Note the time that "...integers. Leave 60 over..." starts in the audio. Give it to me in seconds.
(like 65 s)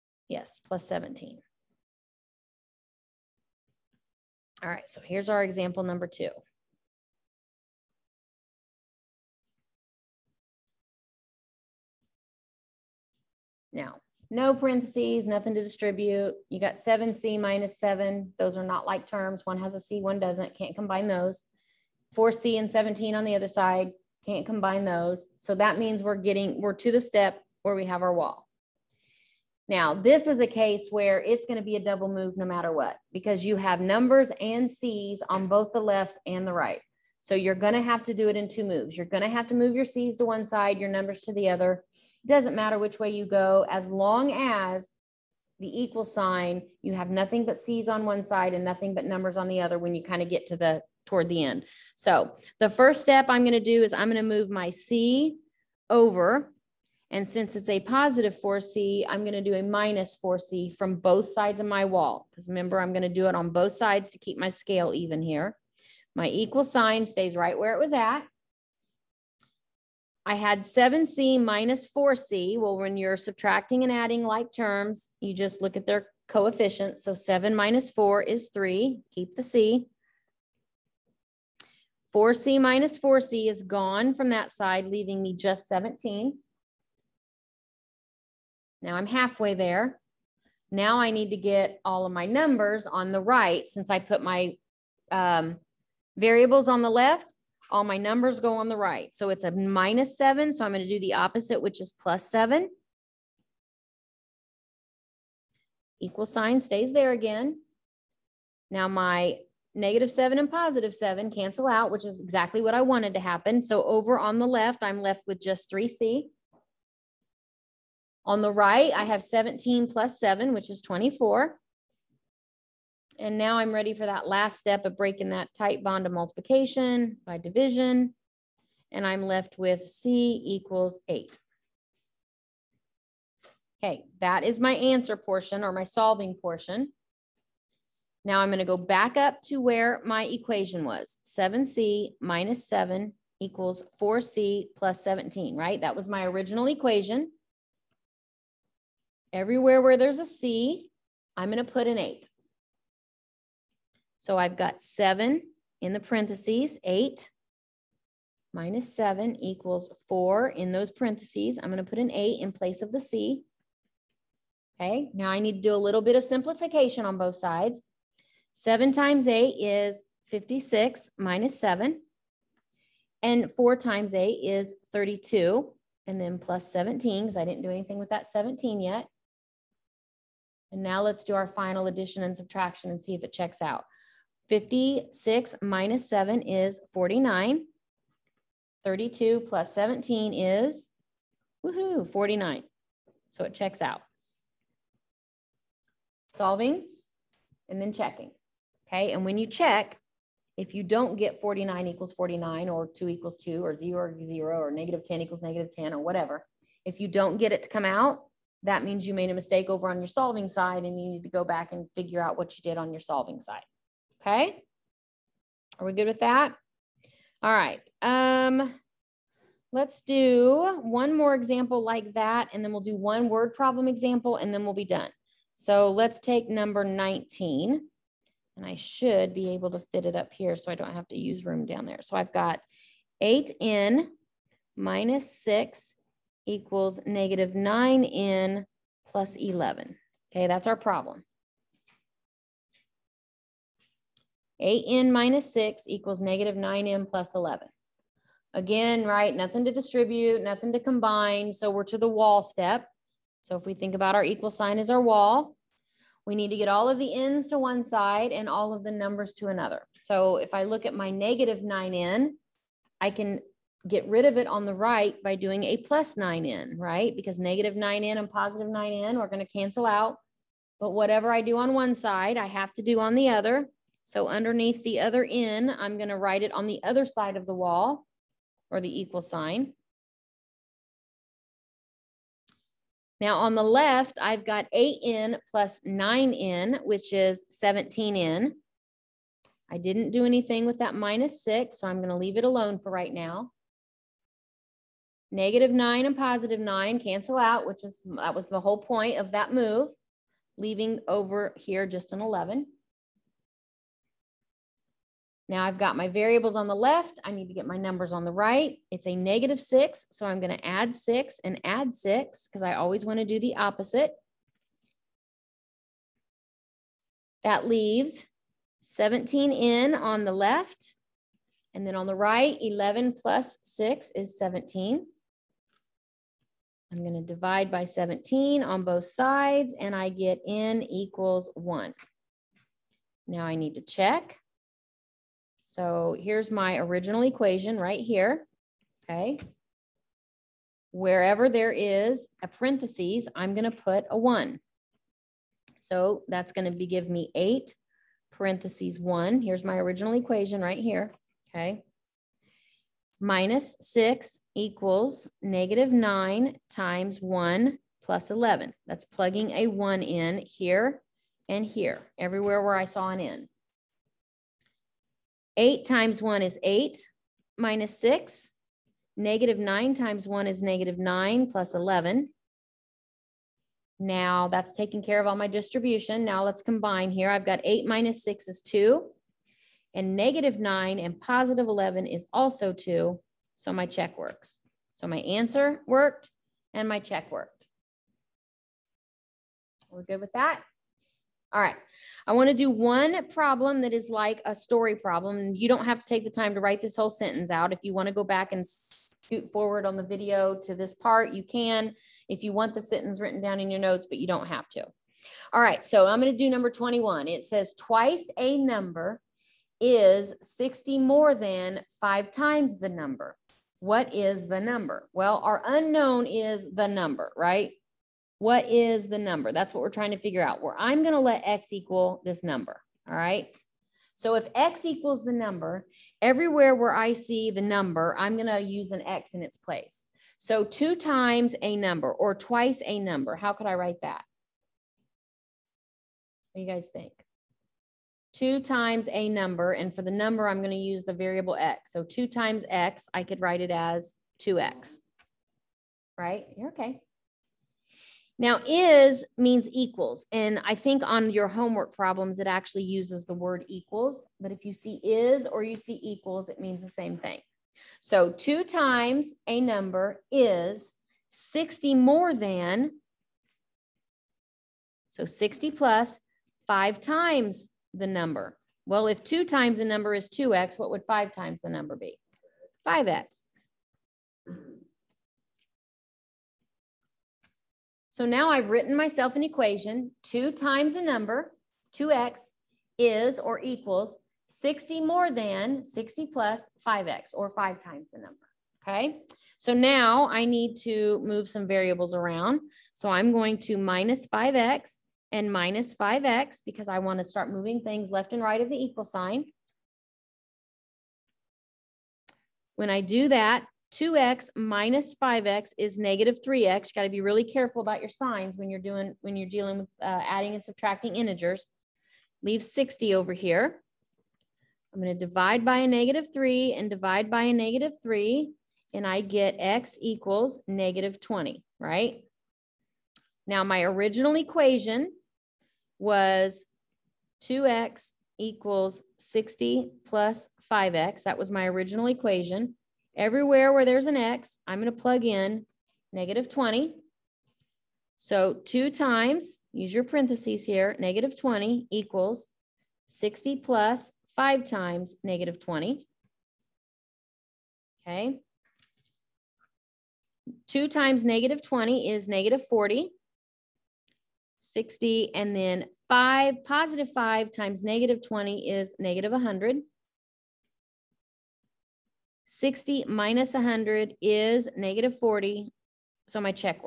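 511 s.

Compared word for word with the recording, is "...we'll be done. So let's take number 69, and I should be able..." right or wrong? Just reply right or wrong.
wrong.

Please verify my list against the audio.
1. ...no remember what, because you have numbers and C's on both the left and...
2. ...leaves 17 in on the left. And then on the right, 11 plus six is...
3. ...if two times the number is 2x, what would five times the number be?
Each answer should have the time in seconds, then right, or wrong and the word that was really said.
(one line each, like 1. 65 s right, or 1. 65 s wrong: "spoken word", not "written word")
1. 32 s wrong: "matter", not "remember"
2. 317 s right
3. 469 s right.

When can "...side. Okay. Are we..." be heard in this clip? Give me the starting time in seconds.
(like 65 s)
213 s.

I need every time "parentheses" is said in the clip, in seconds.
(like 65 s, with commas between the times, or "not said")
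14 s, 156 s, 160 s, 342 s, 348 s, 540 s.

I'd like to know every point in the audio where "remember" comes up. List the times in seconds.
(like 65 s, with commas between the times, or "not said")
62 s.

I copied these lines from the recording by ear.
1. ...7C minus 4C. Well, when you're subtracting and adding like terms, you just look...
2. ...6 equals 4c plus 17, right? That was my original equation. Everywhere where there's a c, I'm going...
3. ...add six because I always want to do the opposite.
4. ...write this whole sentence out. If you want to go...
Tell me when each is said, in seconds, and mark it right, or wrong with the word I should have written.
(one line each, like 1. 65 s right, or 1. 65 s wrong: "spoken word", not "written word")
1. 70 s right
2. 142 s wrong: "7", not "6"
3. 311 s right
4. 396 s right.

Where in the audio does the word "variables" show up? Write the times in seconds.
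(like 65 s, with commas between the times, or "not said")
96 s, 306 s, 441 s, 491 s.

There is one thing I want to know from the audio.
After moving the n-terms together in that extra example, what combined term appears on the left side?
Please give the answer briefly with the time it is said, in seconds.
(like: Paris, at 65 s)
17n, at 287 s.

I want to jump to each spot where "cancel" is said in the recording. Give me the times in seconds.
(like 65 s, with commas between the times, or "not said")
111 s, 269 s, 296 s.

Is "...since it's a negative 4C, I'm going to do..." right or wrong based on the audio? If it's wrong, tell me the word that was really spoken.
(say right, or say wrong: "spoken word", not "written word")
wrong: "positive", not "negative".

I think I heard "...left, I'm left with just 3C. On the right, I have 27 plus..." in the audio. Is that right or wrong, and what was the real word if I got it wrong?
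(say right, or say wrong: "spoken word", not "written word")
wrong: "17", not "27".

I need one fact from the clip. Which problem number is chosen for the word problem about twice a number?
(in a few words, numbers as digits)
21.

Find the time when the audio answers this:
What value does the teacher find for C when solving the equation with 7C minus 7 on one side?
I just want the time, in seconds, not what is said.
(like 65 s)
129 s.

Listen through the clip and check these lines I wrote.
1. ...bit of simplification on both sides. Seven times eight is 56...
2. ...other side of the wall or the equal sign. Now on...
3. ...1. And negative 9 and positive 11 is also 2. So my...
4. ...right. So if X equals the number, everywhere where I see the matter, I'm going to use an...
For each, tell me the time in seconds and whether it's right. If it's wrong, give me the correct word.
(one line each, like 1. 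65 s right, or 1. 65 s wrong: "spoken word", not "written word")
1. 166 s right
2. 276 s right
3. 378 s wrong: "2", not "1"
4. 423 s wrong: "number", not "matter".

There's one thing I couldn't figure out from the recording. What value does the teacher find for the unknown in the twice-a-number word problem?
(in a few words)
-20.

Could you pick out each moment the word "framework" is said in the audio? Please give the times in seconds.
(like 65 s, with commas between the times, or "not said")
not said.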